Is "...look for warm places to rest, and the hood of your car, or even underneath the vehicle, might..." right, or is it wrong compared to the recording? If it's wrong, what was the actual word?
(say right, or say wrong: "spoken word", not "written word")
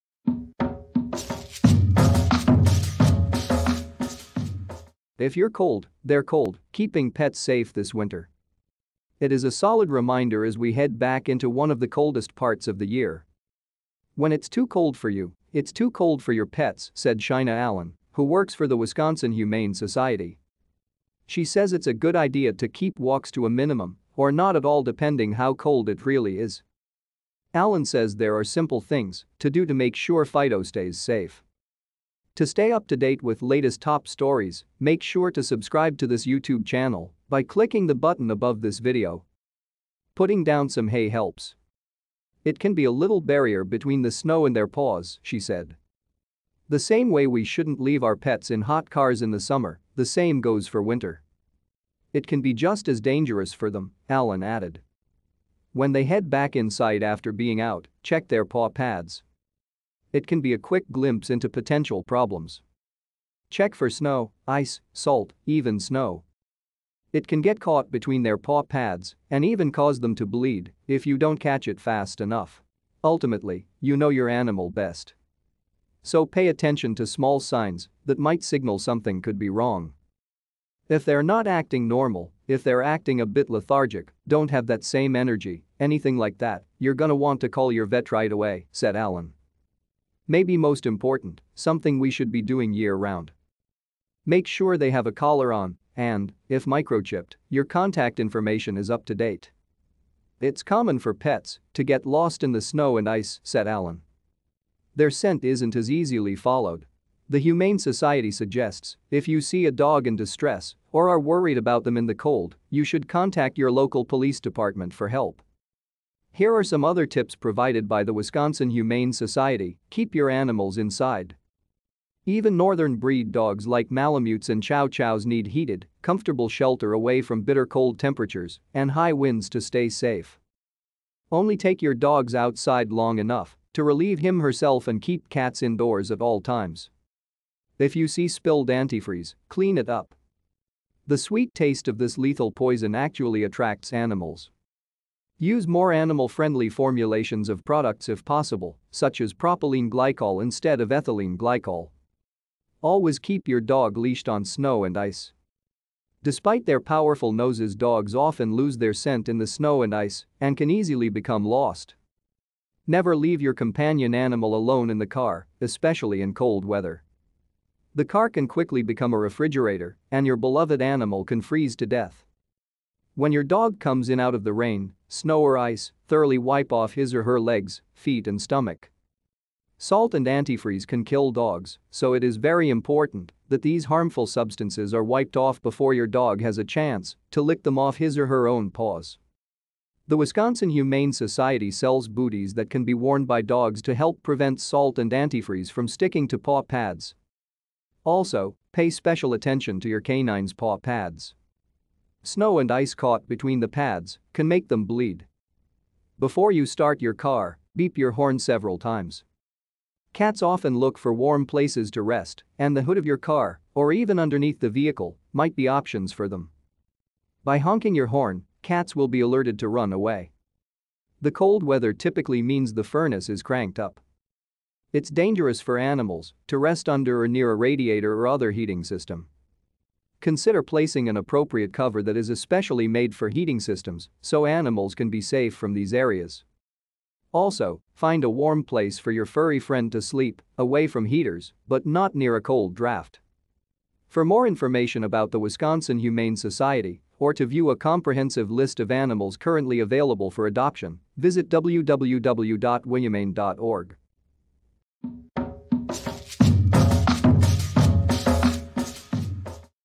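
right.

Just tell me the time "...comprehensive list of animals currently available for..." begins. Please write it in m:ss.
4:07.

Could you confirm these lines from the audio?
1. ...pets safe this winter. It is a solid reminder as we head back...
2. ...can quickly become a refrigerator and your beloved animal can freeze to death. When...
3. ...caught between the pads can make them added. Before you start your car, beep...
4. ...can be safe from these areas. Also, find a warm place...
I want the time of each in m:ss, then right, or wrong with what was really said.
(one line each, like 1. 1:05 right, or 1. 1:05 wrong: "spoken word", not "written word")
1. 0:07 right
2. 2:48 right
3. 3:22 wrong: "bleed", not "added"
4. 3:54 right.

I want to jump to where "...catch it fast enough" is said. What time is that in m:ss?
1:11.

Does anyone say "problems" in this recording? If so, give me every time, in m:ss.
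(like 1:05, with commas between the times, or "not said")
1:02.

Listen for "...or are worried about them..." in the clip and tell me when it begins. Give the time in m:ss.
1:50.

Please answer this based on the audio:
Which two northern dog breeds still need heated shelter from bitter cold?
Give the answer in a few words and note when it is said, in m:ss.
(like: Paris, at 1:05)
Malamutes and Chow Chows, at 2:03.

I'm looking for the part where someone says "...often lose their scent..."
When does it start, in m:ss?
2:38.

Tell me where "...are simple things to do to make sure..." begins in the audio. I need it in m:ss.
0:28.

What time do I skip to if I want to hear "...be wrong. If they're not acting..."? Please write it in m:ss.
1:19.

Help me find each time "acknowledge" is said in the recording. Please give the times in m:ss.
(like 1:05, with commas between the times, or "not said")
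not said.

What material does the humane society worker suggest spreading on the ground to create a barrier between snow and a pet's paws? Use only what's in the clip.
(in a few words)
Hay.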